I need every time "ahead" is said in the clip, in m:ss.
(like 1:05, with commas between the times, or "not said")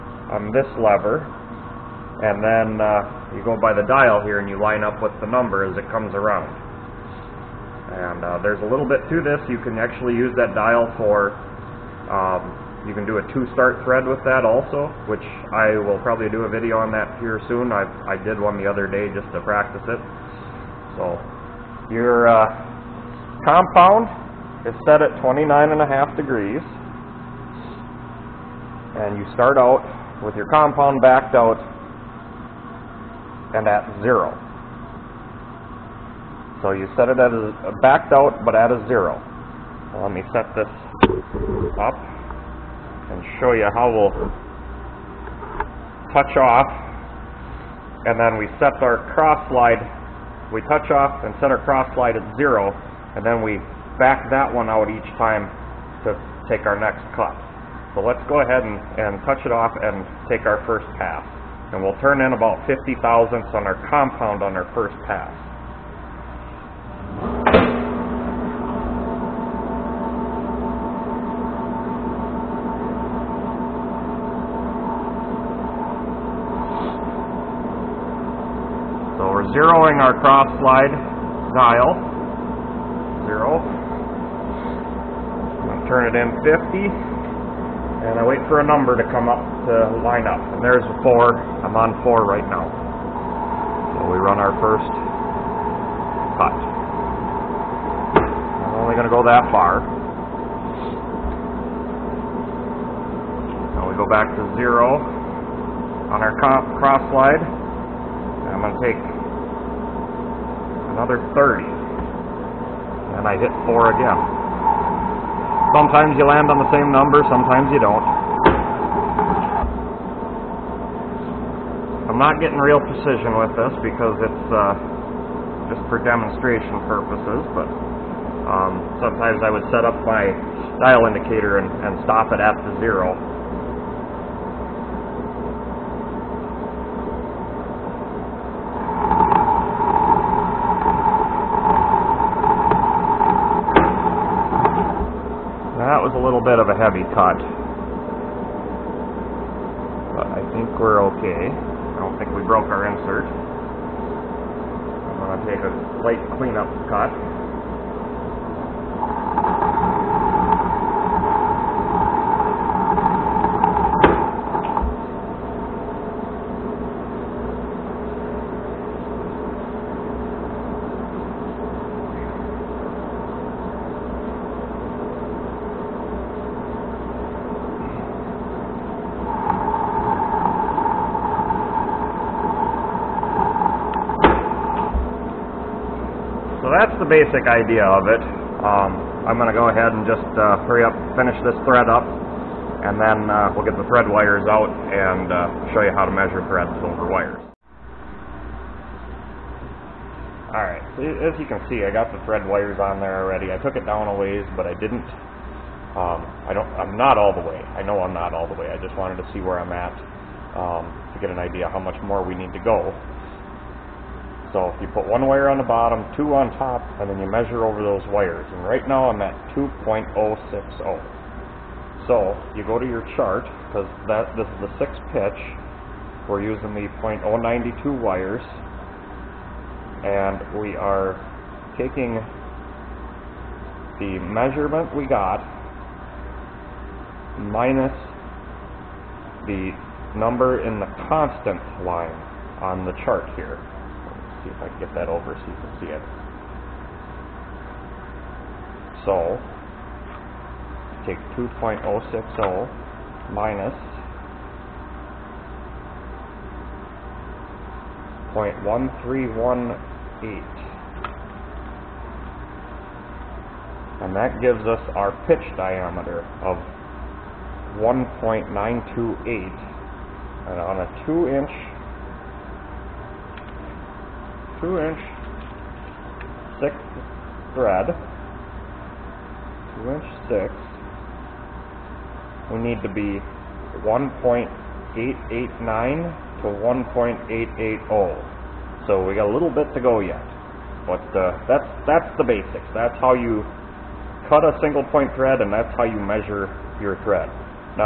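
0:58, 3:09.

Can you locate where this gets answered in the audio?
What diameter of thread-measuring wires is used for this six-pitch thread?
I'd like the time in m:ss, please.
3:47.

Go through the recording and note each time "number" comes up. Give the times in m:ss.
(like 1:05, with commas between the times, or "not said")
0:05, 1:28, 1:56, 4:00.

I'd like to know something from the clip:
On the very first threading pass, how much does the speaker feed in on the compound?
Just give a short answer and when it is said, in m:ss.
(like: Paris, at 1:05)
50 thousandths, at 1:02.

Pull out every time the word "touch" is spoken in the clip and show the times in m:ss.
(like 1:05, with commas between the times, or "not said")
0:46, 0:50, 0:59.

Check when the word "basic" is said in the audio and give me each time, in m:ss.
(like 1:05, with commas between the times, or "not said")
3:07, 4:52.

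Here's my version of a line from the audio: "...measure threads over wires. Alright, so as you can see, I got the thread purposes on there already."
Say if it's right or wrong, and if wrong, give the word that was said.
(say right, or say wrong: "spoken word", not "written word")
wrong: "wires", not "purposes".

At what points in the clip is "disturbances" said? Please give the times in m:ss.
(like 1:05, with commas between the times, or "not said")
not said.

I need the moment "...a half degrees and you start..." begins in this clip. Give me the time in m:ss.
0:25.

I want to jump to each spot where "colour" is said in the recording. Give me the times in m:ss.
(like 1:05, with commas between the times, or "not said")
not said.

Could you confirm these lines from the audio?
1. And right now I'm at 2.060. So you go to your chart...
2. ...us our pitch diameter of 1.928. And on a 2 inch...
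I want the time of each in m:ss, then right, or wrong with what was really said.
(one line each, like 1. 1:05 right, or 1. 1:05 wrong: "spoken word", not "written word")
1. 3:38 right
2. 4:24 right.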